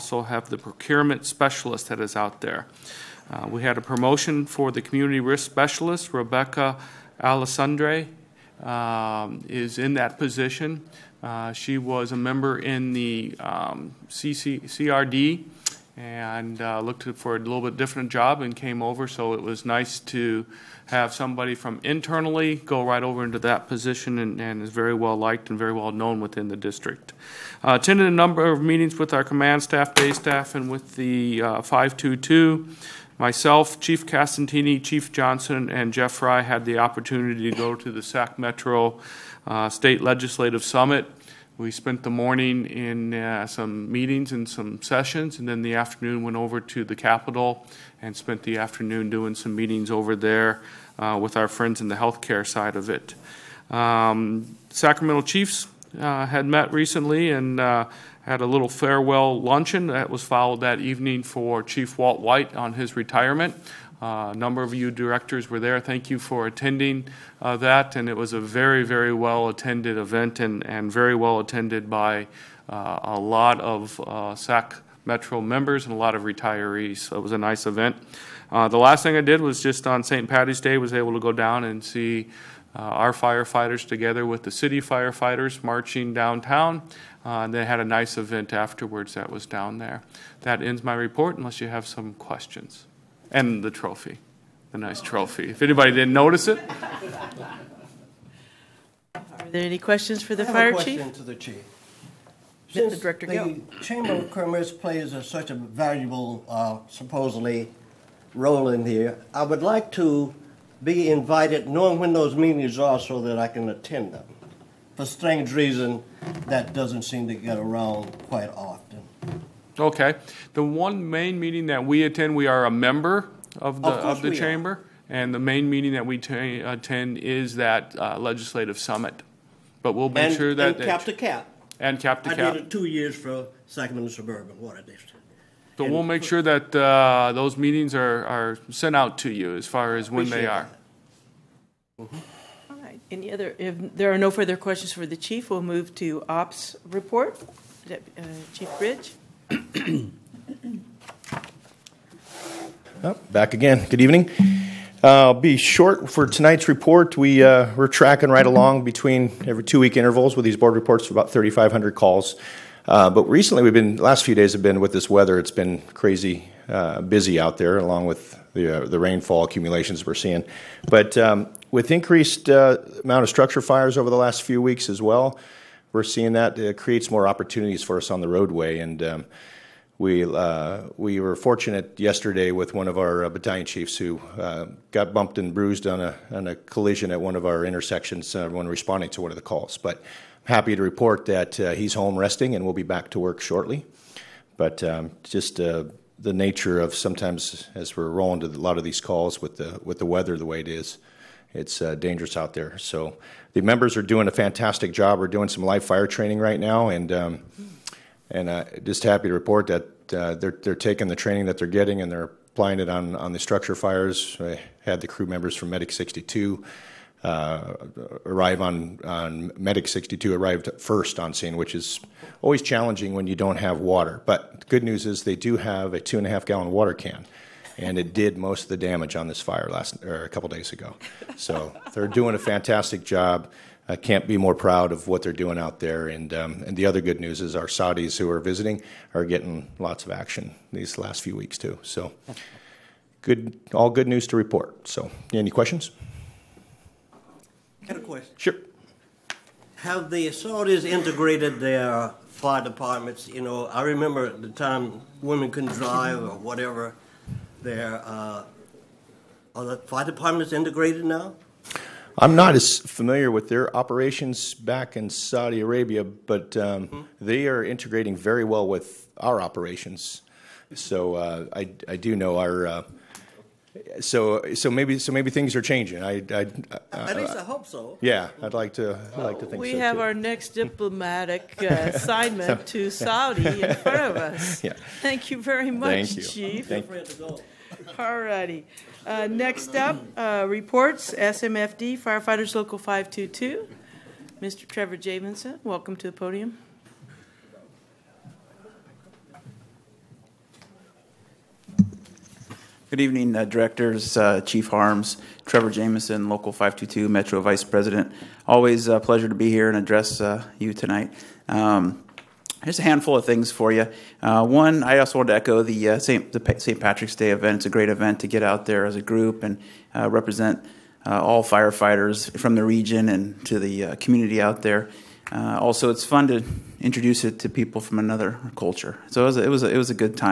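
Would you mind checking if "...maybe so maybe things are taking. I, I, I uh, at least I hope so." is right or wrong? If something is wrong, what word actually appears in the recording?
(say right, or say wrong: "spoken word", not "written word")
wrong: "changing", not "taking".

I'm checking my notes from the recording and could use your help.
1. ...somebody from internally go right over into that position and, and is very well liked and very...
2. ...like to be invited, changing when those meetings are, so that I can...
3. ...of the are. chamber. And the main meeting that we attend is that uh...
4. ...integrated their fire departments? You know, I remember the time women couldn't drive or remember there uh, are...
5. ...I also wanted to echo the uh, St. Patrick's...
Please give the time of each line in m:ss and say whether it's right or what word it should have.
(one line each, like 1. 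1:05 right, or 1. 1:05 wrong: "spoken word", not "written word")
1. 0:21 right
2. 1:49 wrong: "knowing", not "changing"
3. 2:04 right
4. 4:10 wrong: "whatever", not "remember"
5. 5:14 right.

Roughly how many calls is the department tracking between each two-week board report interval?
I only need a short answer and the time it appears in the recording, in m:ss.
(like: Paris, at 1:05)
3,500, at 2:41.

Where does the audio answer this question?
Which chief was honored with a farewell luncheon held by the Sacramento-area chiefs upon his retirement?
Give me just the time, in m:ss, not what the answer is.
1:01.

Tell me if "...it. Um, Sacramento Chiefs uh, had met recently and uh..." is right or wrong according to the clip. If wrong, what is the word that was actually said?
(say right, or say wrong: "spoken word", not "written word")
right.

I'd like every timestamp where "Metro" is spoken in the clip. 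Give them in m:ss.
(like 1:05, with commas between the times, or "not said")
0:38, 1:15, 5:07.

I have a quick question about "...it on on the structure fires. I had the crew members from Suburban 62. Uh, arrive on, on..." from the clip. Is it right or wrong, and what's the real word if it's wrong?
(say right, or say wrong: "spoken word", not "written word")
wrong: "Medic", not "Suburban".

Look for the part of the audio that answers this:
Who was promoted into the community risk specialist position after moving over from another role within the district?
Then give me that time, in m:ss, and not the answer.
0:06.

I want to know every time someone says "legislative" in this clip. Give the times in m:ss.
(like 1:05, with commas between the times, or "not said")
0:40, 2:08.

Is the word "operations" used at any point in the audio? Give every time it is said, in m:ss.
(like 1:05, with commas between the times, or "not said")
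4:23, 4:29.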